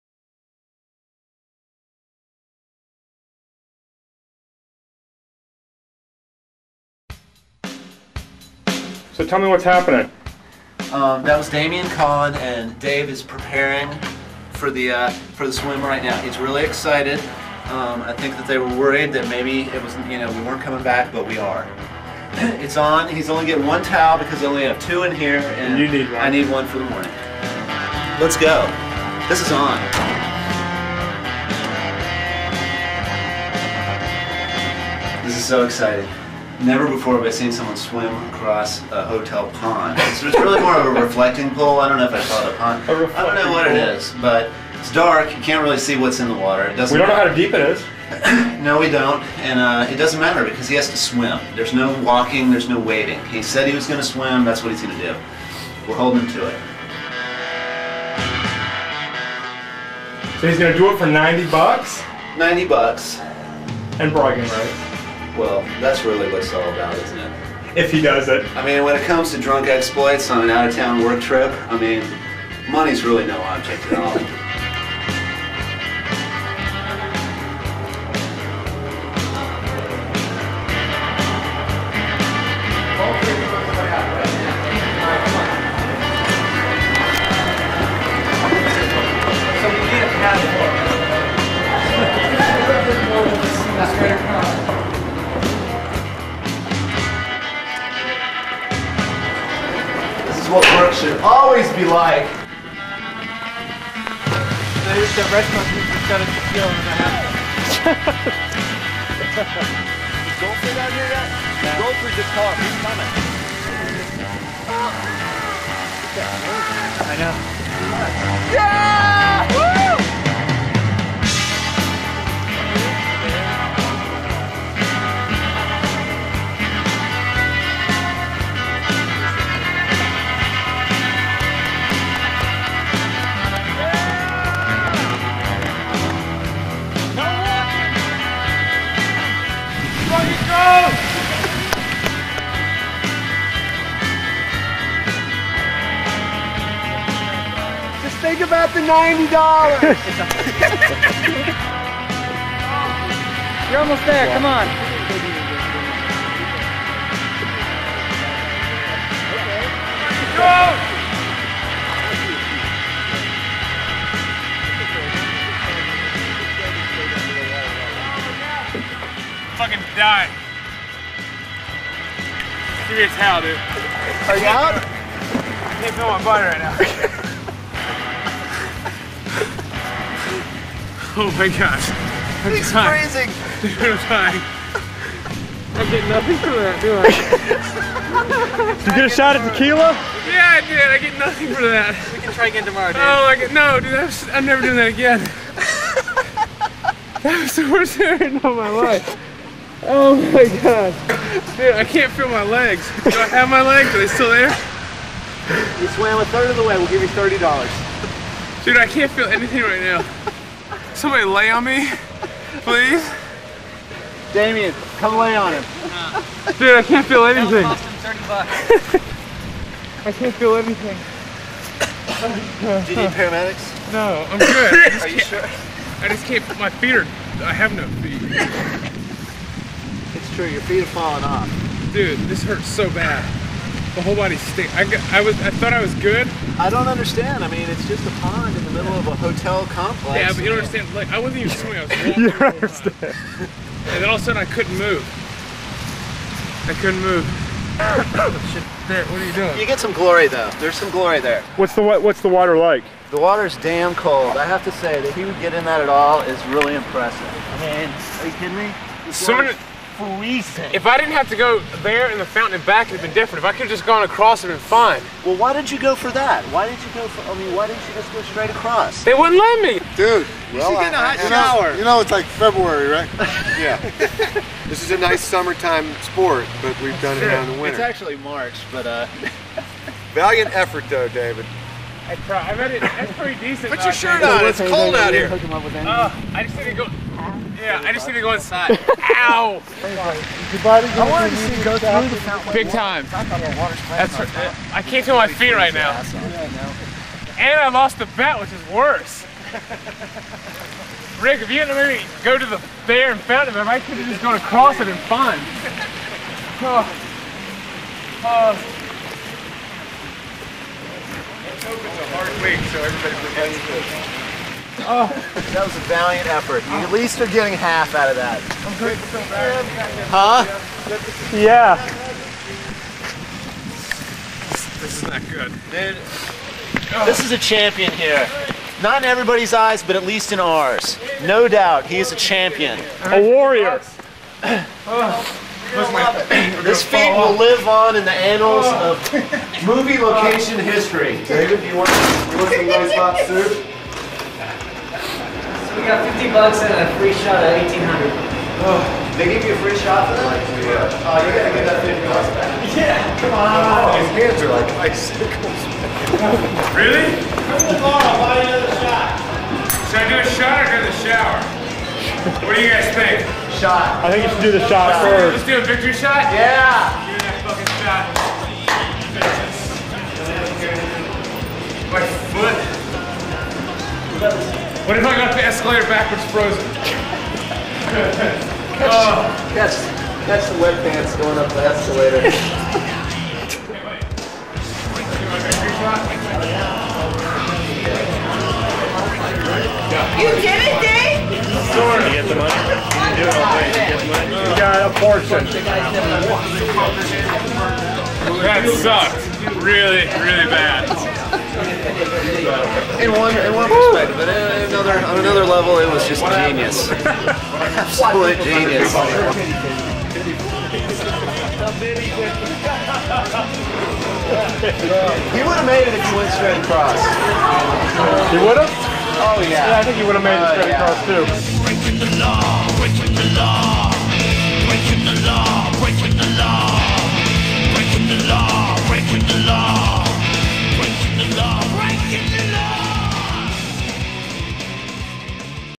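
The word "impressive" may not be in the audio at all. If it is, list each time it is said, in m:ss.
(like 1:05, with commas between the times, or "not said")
4:16.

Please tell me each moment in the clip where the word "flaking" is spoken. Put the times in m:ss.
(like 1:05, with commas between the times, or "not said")
not said.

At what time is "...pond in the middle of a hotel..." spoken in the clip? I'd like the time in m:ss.
3:58.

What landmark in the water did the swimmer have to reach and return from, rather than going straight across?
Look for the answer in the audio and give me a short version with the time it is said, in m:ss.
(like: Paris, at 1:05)
the fountain, at 4:22.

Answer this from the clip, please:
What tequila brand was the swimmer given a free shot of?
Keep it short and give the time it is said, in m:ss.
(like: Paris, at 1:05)
1800, at 5:47.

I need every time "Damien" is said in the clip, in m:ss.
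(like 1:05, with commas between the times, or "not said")
0:11, 3:34.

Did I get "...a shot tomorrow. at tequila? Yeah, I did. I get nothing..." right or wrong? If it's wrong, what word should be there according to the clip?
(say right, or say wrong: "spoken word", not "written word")
right.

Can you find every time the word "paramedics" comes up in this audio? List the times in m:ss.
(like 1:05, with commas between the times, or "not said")
3:43.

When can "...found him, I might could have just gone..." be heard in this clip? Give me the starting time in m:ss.
5:03.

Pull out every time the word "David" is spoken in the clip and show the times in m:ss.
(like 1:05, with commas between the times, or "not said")
4:41, 5:41.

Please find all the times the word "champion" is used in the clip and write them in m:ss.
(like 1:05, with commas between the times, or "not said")
5:27, 5:32.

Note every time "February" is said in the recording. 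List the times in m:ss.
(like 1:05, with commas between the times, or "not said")
4:32.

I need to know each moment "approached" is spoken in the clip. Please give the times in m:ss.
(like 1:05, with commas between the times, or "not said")
not said.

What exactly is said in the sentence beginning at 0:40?
So it's really more of a reflecting pool.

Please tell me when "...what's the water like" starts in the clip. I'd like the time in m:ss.
4:11.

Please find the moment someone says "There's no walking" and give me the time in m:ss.
0:51.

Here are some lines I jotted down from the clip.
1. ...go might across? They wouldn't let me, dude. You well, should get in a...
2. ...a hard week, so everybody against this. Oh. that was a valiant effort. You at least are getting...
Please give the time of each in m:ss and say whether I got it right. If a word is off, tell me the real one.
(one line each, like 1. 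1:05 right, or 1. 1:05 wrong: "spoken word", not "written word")
1. 4:28 wrong: "straight", not "might"
2. 5:11 right.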